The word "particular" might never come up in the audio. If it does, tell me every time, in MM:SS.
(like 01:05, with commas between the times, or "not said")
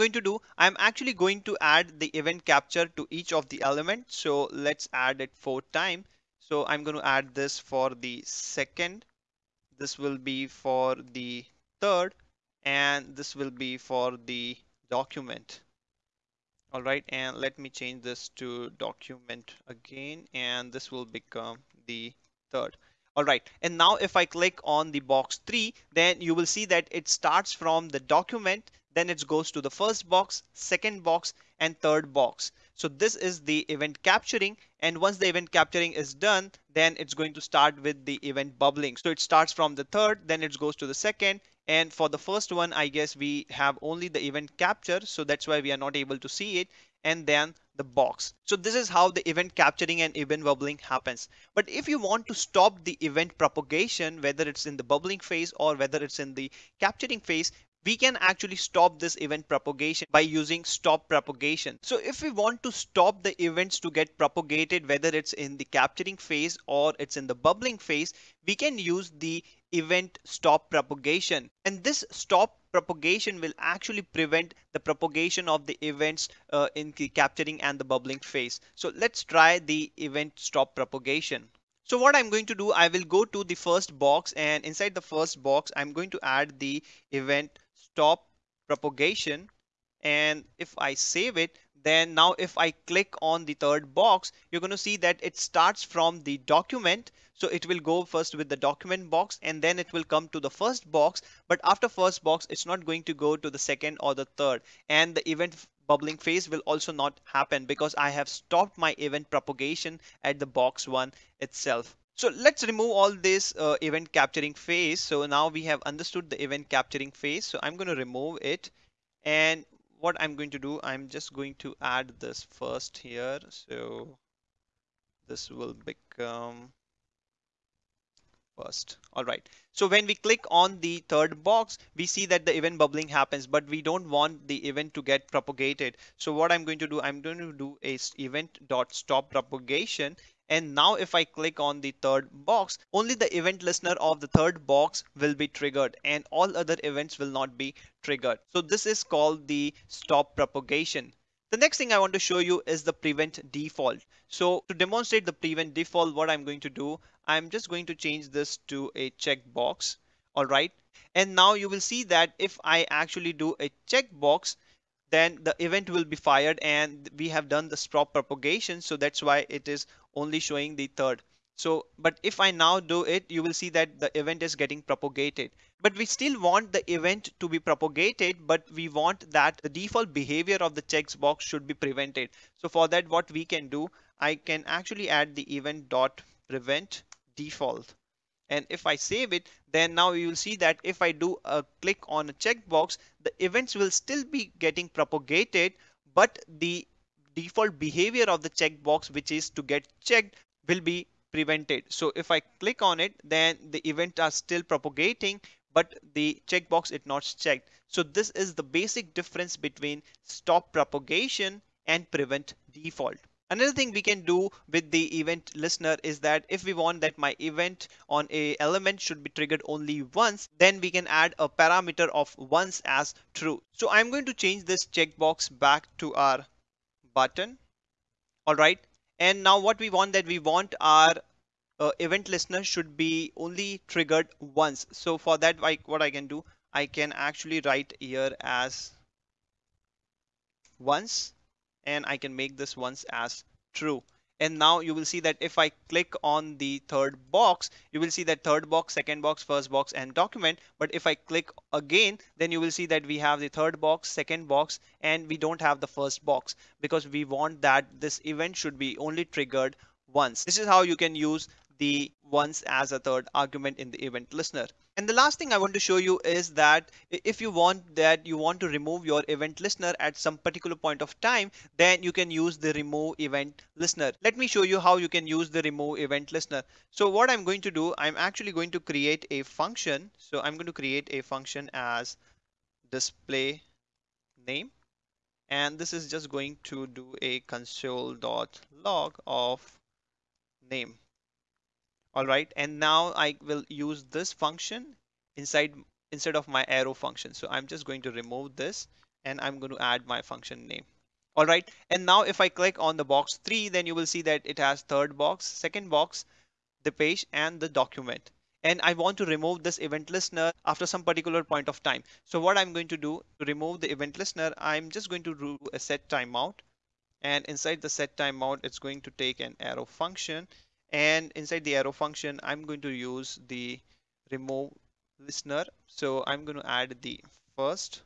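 04:30, 05:11.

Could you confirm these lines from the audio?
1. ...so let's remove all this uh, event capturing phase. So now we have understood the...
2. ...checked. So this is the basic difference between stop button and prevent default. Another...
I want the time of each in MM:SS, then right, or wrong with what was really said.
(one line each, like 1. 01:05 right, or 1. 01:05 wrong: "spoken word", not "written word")
1. 01:52 right
2. 03:27 wrong: "propagation", not "button".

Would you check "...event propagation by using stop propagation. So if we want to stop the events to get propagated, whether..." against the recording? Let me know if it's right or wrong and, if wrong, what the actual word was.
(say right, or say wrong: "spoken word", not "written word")
right.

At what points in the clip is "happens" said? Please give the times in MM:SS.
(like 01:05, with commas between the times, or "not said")
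00:50, 01:47, 02:13.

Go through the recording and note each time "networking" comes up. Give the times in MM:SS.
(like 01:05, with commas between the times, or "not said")
not said.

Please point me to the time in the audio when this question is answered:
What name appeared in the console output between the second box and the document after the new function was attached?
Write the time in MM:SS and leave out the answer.
05:06.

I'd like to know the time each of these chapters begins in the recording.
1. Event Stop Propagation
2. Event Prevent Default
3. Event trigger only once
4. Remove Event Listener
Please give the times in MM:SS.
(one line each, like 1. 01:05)
1. 00:51
2. 02:31
3. 03:33
4. 04:24.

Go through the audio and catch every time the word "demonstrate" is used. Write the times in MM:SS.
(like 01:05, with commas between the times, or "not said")
02:34.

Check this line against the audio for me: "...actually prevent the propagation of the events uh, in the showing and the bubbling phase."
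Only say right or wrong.
wrong.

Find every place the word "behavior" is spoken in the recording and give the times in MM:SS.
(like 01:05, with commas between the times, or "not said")
03:00, 03:17.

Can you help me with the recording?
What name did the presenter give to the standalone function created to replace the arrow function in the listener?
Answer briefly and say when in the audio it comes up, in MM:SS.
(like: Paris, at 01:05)
display name, at 04:42.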